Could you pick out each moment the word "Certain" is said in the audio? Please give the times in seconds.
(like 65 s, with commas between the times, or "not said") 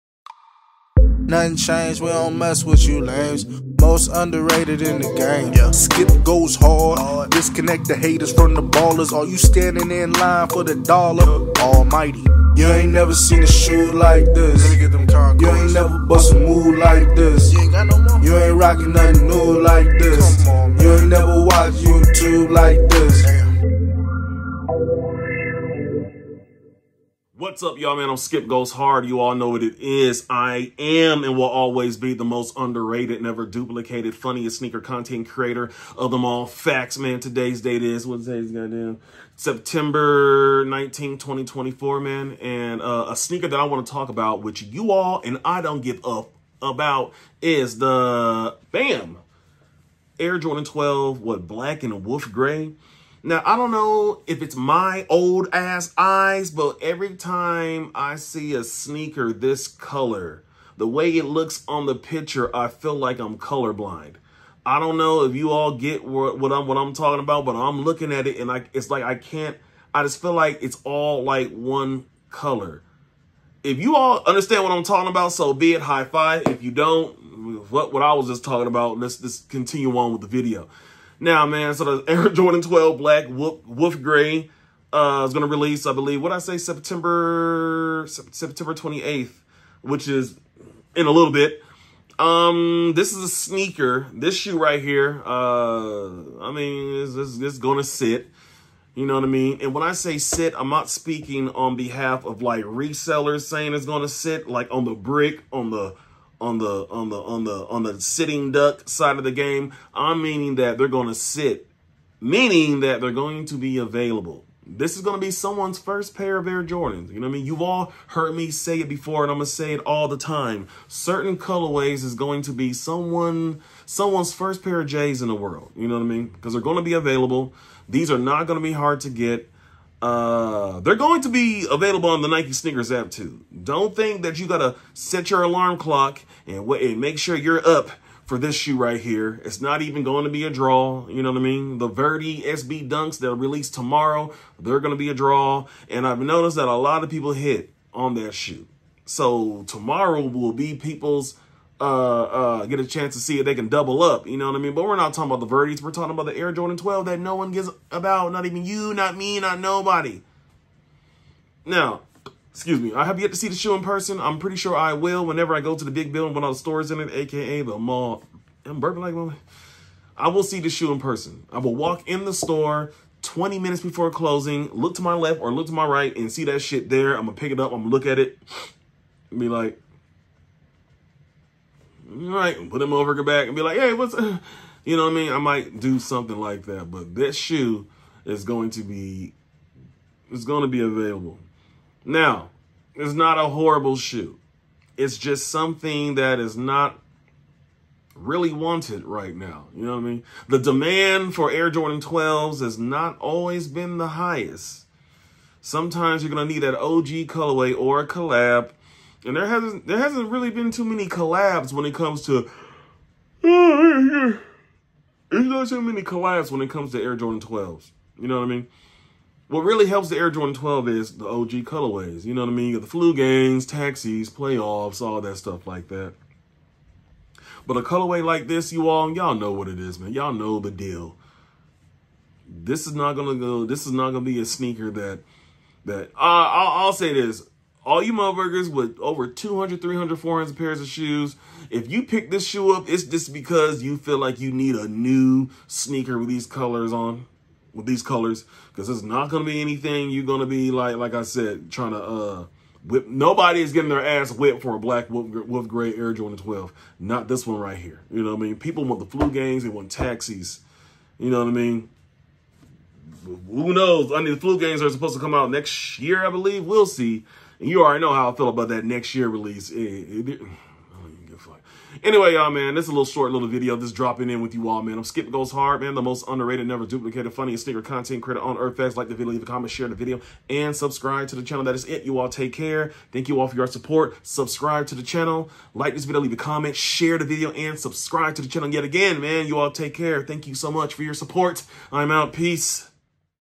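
120 s.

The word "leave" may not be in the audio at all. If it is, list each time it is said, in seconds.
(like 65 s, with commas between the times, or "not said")
279 s, 286 s.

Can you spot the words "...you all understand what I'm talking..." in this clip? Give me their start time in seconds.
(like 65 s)
73 s.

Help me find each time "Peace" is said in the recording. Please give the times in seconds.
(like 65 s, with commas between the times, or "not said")
292 s.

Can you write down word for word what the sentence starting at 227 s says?
But a colorway like this, you all, y'all know what it is, man.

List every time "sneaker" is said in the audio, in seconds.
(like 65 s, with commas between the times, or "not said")
34 s, 43 s, 58 s, 93 s, 132 s, 234 s, 245 s, 277 s.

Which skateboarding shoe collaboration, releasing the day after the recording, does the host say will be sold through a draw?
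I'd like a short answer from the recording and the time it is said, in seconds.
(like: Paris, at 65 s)
Verdy SB Dunks, at 141 s.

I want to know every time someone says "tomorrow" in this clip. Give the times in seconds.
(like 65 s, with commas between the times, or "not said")
143 s, 149 s.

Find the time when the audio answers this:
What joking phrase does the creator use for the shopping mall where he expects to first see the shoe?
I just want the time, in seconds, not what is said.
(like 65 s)
165 s.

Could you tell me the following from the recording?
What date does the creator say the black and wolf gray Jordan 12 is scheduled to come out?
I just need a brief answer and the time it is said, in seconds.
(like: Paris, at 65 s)
September 28th, at 86 s.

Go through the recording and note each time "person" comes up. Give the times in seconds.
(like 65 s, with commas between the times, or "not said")
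163 s, 170 s.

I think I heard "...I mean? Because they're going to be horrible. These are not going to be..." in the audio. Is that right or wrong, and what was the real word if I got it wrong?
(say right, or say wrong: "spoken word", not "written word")
wrong: "available", not "horrible".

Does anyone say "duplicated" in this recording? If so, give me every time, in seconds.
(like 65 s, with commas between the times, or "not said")
33 s, 276 s.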